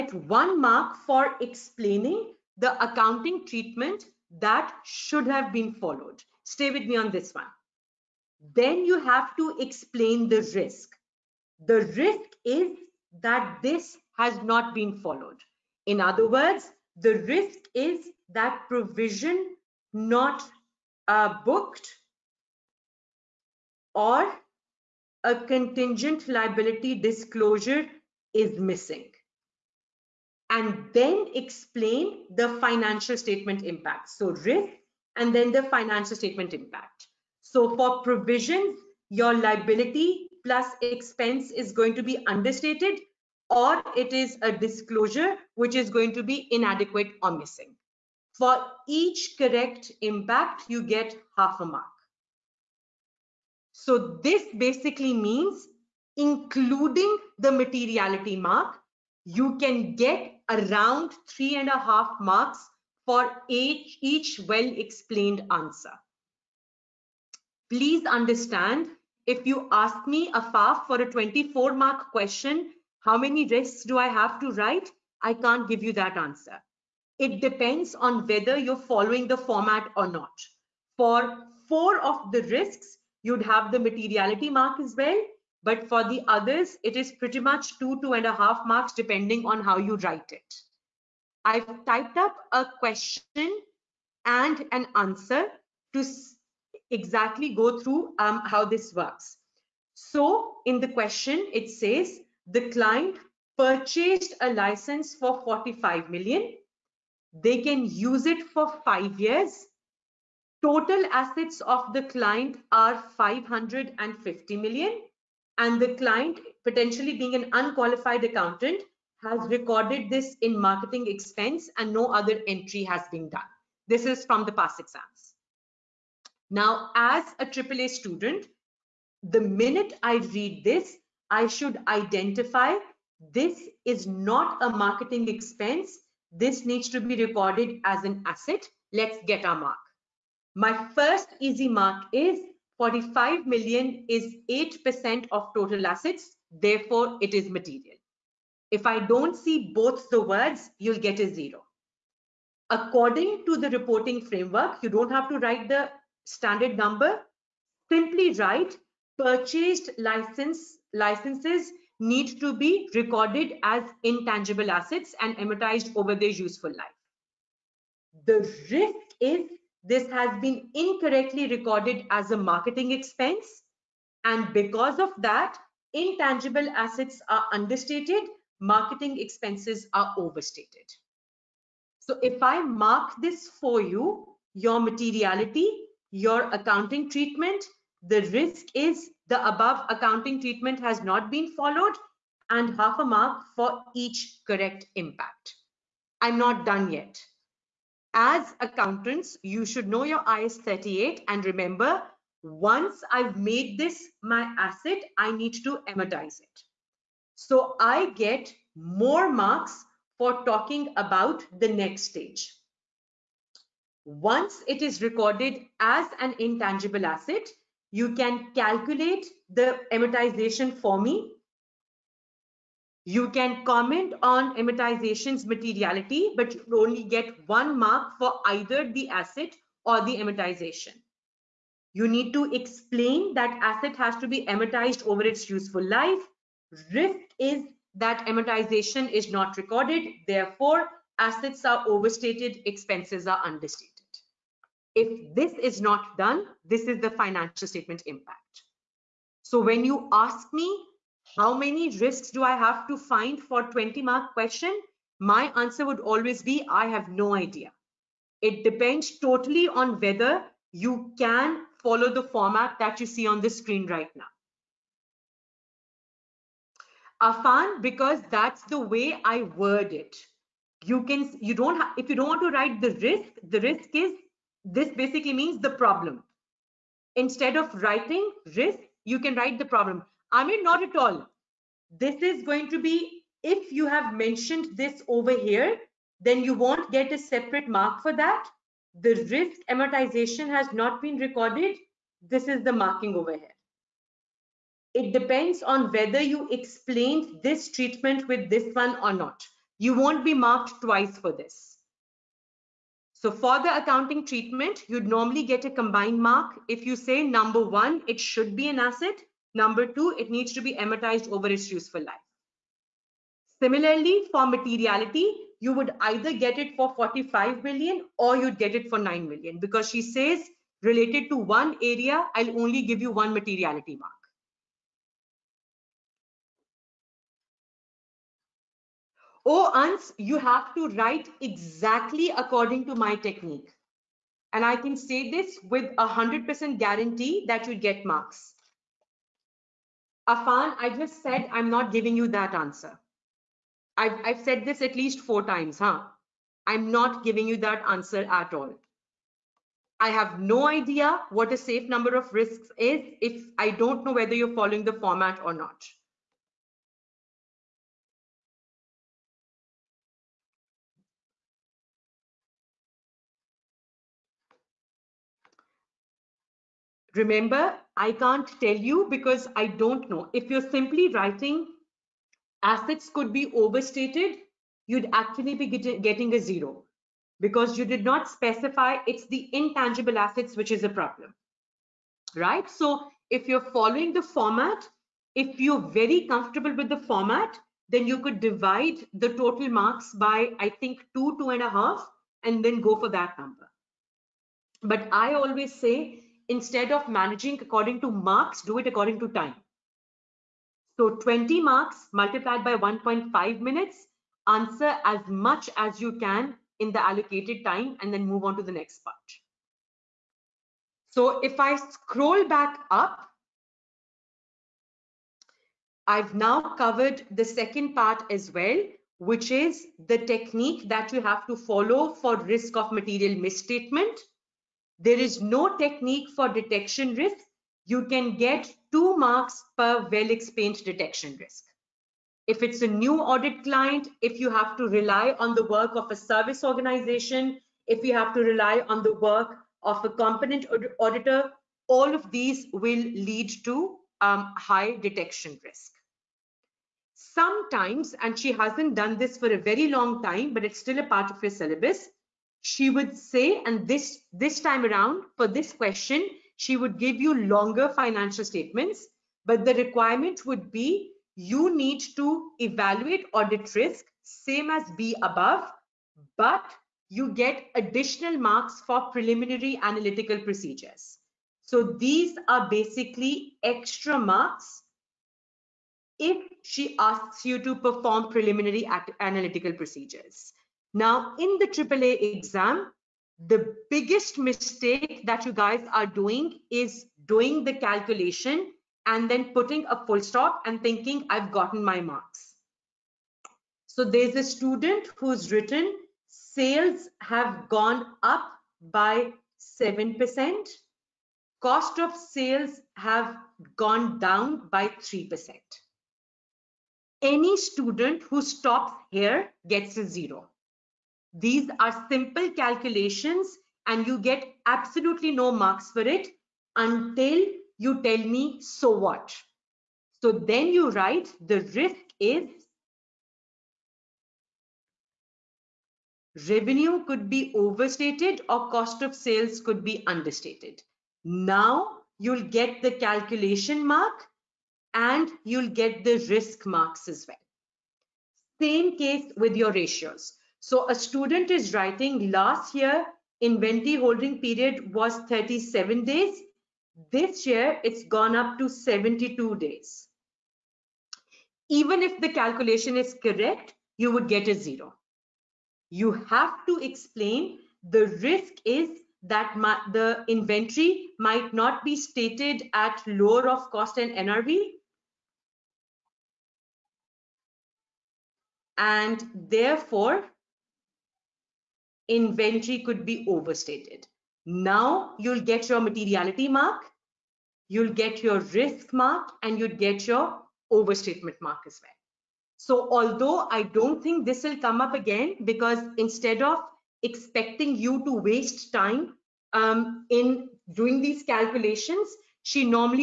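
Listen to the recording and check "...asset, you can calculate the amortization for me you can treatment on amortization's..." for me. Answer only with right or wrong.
wrong.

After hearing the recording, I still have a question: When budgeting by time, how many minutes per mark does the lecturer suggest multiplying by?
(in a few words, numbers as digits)
1.5.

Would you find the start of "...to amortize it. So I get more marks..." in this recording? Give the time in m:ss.
3:25.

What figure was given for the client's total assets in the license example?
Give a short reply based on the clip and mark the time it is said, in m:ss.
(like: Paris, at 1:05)
550 million, at 1:53.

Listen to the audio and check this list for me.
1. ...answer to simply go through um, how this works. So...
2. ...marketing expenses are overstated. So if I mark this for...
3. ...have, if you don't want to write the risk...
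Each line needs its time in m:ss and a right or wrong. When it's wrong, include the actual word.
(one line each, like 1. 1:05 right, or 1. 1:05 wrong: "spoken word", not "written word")
1. 1:34 wrong: "exactly", not "simply"
2. 2:58 right
3. 4:31 right.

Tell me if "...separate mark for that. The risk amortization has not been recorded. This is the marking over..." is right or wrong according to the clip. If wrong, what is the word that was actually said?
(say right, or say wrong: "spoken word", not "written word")
right.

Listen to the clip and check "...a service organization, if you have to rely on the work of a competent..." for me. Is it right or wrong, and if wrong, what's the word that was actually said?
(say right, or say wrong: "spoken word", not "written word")
right.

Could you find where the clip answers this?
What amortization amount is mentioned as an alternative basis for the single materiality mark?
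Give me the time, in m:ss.
5:18.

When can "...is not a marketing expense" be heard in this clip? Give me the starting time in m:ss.
2:13.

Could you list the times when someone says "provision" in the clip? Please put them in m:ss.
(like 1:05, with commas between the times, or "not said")
0:18, 0:38.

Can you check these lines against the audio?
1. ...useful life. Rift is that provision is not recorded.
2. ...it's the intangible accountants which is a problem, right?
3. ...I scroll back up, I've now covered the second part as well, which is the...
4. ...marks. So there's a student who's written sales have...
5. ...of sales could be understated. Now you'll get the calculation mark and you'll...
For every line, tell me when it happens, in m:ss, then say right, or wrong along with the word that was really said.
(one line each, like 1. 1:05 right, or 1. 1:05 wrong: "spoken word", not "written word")
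1. 3:55 wrong: "amortization", not "provision"
2. 6:19 wrong: "assets", not "accountants"
3. 6:51 right
4. 8:11 right
5. 8:49 right.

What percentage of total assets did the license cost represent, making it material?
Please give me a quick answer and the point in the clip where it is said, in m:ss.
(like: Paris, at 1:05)
8%, at 2:24.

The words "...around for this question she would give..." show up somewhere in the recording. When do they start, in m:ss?
7:34.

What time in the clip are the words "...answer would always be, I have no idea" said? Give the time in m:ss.
4:15.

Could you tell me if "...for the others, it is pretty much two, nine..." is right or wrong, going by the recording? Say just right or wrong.
wrong.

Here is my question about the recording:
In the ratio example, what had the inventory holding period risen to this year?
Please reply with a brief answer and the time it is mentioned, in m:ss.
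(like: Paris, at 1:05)
72 days, at 9:08.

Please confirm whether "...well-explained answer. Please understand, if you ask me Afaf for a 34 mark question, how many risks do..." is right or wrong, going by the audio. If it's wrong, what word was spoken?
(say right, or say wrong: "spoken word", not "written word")
wrong: "24", not "34".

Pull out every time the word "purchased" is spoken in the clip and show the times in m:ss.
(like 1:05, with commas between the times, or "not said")
1:43, 2:39.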